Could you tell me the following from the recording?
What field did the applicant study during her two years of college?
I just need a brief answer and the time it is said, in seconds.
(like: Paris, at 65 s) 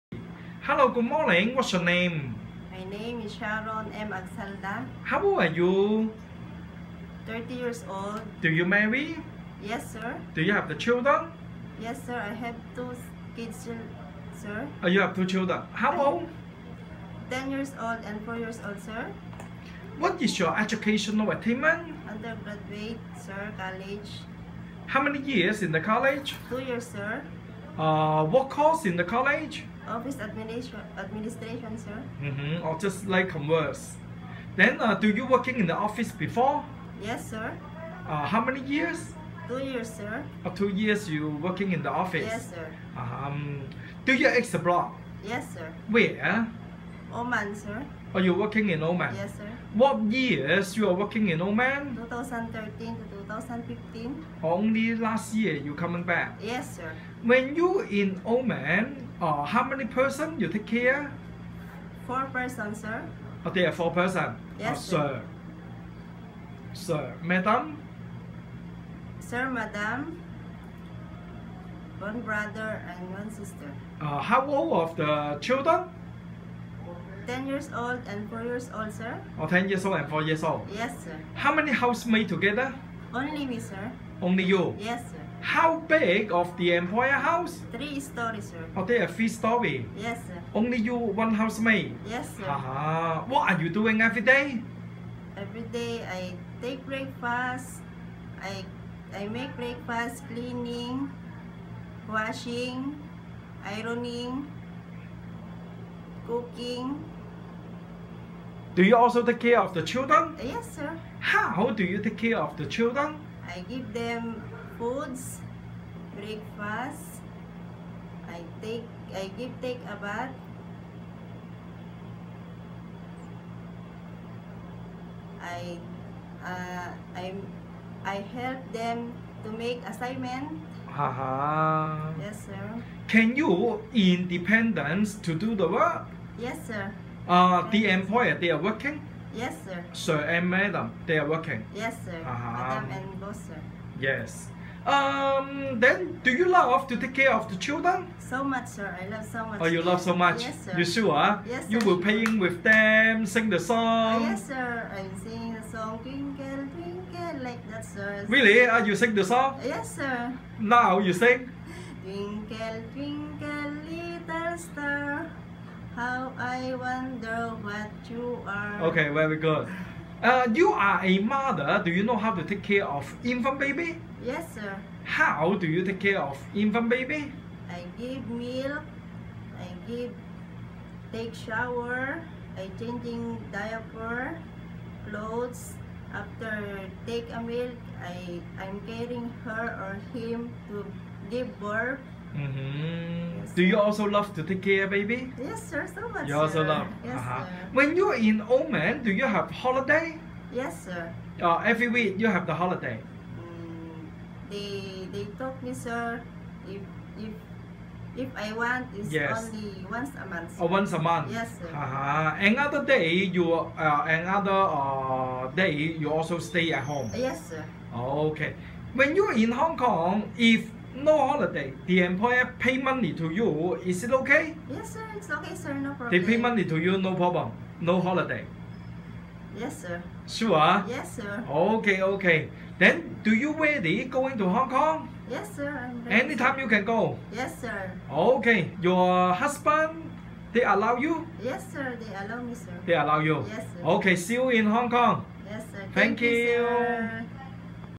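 Office administration, at 29 s.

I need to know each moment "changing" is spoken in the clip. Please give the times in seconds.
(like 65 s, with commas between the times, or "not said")
182 s.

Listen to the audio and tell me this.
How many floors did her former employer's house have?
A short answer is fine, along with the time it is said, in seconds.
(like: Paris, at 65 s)
3, at 87 s.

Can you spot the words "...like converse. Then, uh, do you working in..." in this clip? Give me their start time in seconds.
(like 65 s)
33 s.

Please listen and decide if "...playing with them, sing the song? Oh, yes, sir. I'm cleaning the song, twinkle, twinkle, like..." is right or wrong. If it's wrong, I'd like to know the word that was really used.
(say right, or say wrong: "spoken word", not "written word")
wrong: "singing", not "cleaning".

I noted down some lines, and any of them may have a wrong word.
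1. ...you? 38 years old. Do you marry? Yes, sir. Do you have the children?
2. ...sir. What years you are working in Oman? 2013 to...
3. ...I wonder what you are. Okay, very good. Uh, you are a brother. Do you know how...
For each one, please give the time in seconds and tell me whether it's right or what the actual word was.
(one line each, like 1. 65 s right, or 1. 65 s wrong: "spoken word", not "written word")
1. 5 s wrong: "30", not "38"
2. 49 s right
3. 166 s wrong: "mother", not "brother".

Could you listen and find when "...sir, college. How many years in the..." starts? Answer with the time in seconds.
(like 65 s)
23 s.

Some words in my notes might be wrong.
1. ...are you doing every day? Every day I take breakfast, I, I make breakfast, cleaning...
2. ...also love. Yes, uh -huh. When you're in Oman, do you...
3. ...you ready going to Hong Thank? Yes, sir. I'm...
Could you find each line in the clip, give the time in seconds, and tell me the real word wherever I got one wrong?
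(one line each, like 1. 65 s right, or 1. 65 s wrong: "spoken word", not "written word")
1. 93 s right
2. 196 s right
3. 233 s wrong: "Kong", not "Thank".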